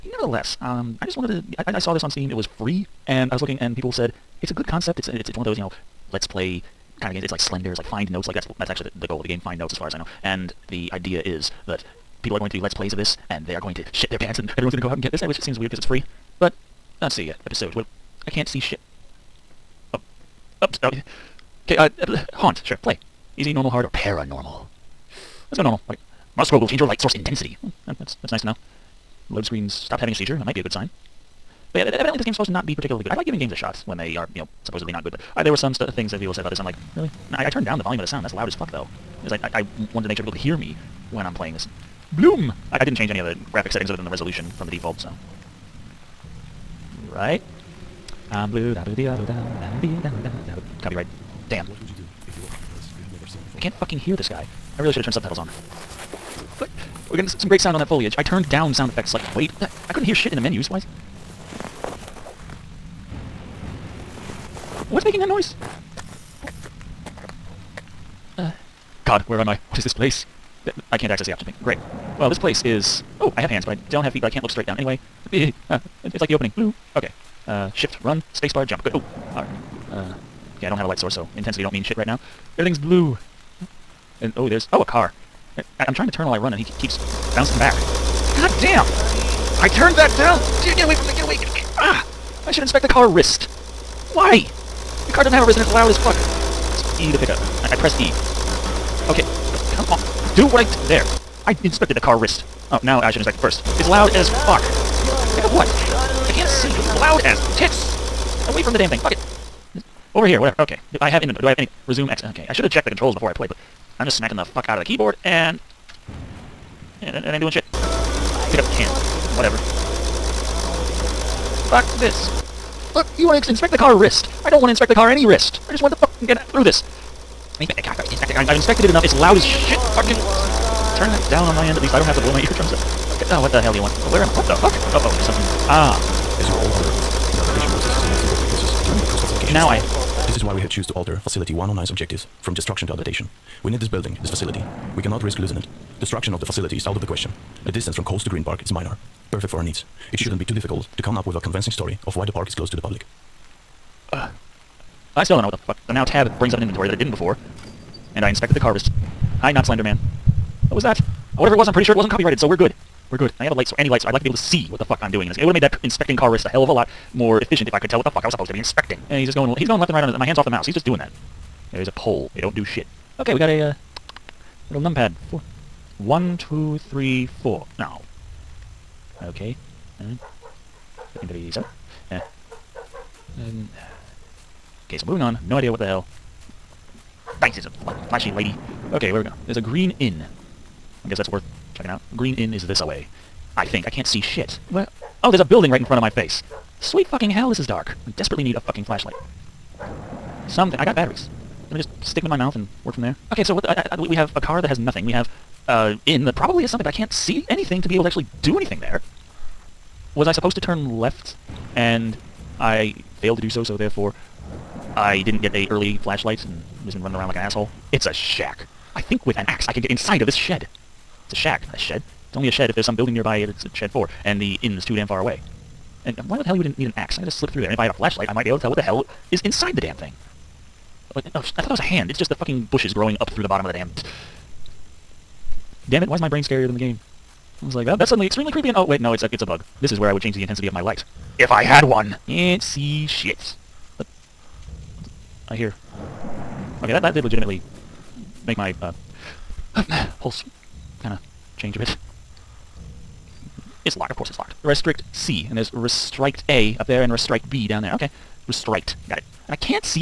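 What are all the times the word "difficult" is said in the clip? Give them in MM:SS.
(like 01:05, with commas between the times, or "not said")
02:30.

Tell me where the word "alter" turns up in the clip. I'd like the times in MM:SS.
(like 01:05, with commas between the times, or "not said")
02:20.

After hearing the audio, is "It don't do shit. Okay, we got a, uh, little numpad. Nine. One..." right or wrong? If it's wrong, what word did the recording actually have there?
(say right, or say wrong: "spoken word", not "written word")
wrong: "Four", not "Nine".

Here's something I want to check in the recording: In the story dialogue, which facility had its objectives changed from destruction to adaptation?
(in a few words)
Facility 109.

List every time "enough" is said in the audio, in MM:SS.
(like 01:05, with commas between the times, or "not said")
02:08.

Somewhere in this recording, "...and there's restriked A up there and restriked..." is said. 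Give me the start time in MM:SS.
04:15.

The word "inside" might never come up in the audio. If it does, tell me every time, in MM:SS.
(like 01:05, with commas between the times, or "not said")
03:39, 03:49.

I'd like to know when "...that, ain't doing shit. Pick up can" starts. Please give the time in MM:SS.
01:57.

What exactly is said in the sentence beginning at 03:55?
Damn it, why is my brain scarier than the game?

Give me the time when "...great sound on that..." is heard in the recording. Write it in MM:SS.
00:57.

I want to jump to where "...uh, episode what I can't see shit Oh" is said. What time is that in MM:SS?
00:17.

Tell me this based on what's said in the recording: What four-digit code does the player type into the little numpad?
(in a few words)
1337.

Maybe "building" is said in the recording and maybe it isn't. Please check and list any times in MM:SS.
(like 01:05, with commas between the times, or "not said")
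02:23, 03:15, 03:42.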